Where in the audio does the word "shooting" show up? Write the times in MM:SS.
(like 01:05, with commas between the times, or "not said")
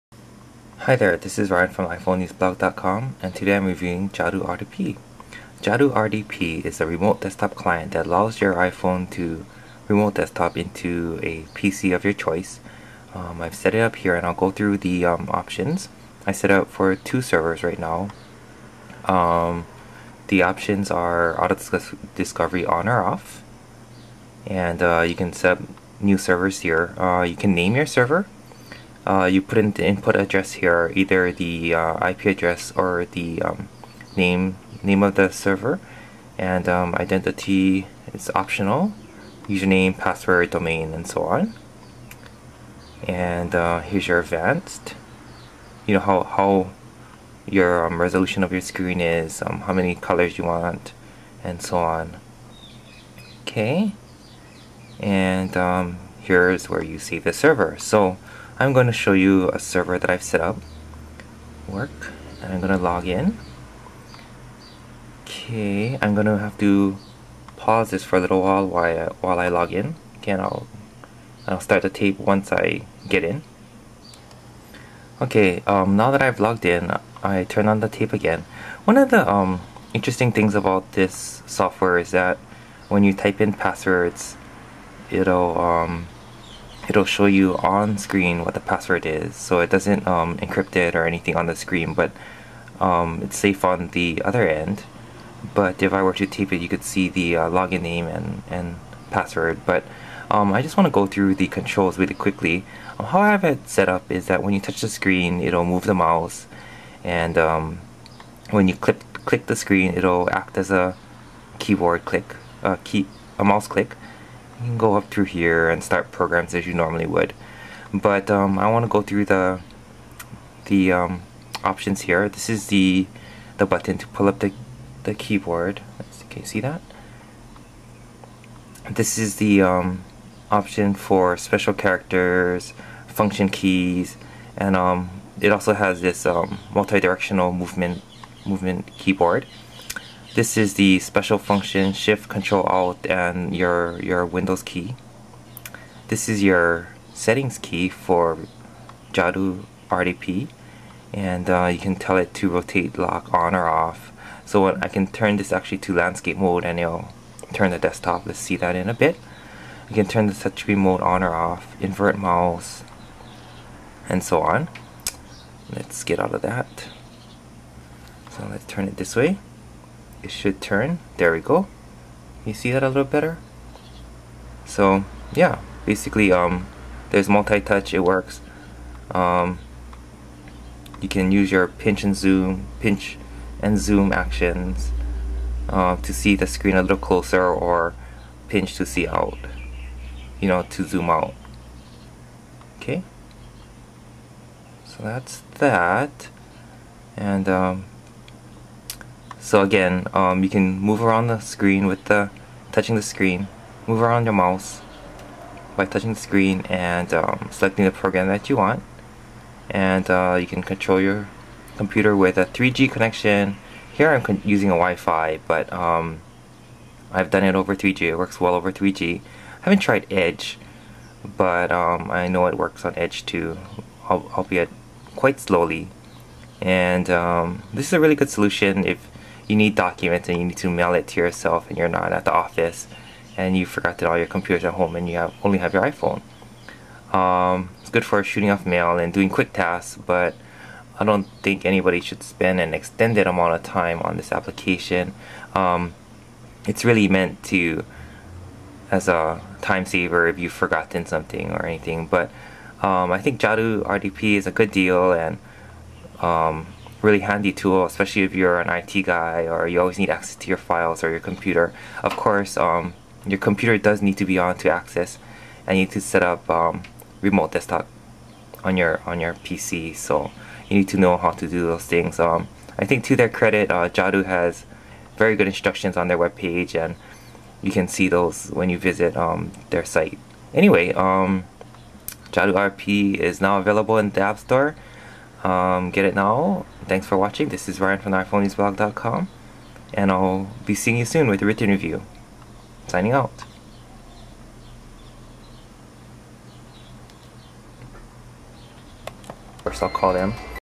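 03:58.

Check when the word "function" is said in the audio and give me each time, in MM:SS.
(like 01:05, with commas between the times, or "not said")
02:13, 02:21.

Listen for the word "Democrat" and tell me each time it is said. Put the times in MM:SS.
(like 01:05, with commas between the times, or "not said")
not said.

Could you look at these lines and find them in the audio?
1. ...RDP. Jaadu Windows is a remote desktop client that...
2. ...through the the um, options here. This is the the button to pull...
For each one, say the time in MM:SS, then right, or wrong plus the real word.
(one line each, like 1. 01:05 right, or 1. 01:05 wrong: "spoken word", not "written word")
1. 00:04 wrong: "RDP", not "Windows"
2. 01:59 right.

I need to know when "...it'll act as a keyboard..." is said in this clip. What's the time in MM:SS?
01:49.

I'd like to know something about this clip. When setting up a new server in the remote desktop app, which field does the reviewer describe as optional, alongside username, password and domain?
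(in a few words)
Identity.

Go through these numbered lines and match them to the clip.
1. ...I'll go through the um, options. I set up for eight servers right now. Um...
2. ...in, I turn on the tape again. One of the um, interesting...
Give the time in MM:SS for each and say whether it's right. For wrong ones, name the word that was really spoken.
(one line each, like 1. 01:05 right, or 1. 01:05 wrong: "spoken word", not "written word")
1. 00:14 wrong: "two", not "eight"
2. 01:16 right.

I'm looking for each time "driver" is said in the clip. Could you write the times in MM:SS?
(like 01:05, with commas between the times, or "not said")
not said.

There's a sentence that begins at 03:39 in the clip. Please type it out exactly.
I haven't tried Edge, but um, I know it works on Edge too, albeit quite slowly.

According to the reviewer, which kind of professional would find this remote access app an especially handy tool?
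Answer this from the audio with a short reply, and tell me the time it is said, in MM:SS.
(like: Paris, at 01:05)
IT guy, at 04:18.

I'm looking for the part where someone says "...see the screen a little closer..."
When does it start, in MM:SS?
03:06.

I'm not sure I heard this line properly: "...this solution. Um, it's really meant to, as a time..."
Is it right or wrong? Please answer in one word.
wrong.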